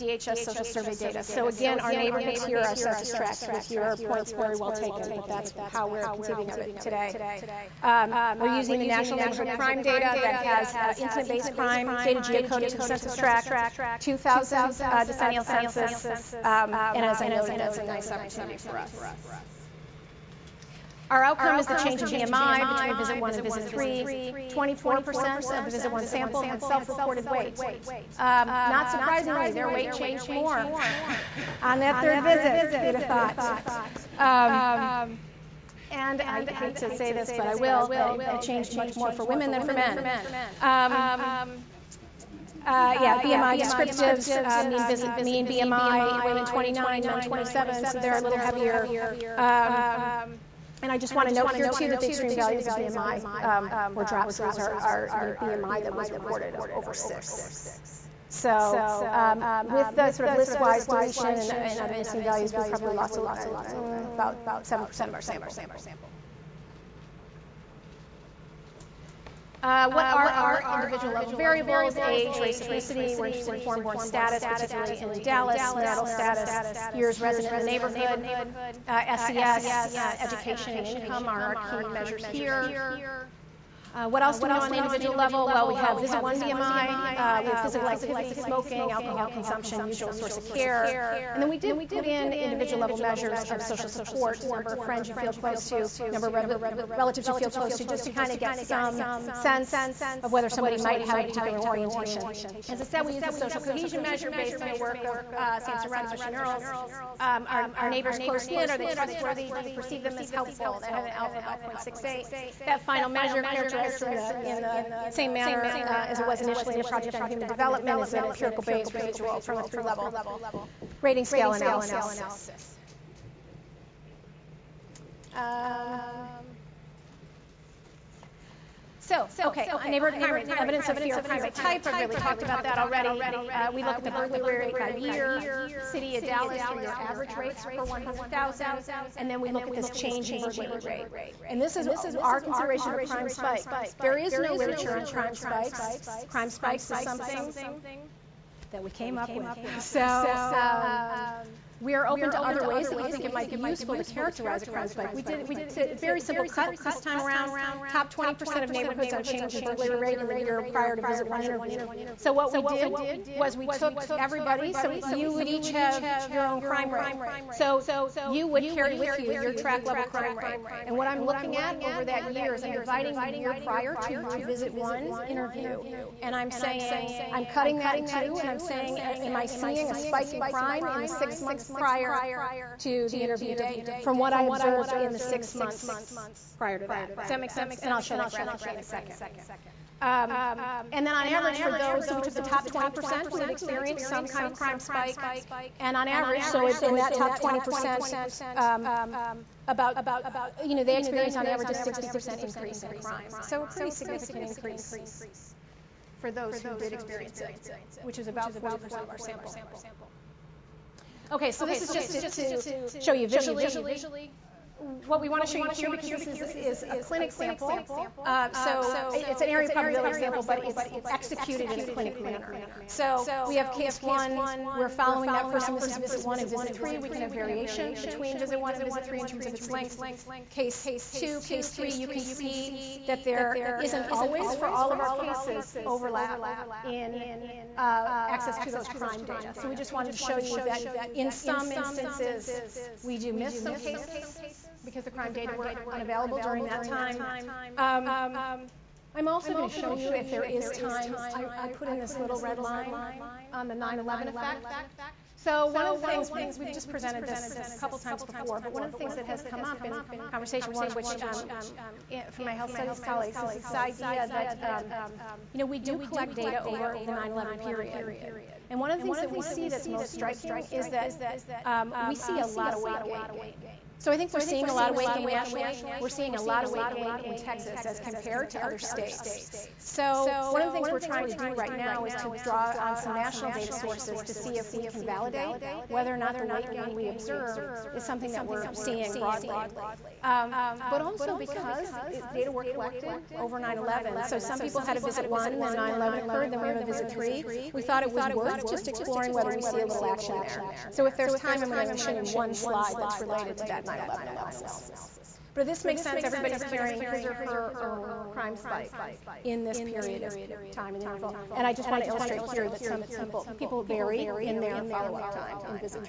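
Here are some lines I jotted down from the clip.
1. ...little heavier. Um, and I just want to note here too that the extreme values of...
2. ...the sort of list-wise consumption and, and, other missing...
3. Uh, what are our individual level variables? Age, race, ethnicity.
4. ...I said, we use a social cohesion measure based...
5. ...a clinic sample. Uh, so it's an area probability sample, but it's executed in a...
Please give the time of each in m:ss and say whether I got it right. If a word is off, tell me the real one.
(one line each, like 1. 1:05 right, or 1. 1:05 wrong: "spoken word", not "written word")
1. 0:48 right
2. 0:59 wrong: "deletion", not "consumption"
3. 1:09 right
4. 1:42 right
5. 3:36 right.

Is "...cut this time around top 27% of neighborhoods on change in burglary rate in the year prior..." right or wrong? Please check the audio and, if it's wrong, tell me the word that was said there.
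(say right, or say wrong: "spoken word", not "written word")
wrong: "20", not "27".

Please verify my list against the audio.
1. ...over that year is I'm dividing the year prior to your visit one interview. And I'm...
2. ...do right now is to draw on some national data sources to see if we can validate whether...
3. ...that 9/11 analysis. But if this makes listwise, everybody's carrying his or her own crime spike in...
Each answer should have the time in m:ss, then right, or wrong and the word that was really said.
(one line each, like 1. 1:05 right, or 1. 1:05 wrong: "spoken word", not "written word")
1. 2:51 right
2. 4:41 right
3. 5:03 wrong: "sense", not "listwise".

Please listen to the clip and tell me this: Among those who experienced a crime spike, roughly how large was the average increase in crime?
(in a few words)
60%.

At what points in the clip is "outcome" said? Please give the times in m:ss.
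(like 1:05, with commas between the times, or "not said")
0:21.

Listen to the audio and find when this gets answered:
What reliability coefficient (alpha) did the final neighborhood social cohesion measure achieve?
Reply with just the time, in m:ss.
1:51.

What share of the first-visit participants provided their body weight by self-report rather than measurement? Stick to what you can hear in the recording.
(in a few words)
24%.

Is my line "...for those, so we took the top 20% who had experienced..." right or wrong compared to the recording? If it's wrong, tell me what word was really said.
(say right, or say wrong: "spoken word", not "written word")
right.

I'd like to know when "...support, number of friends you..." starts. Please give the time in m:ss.
1:33.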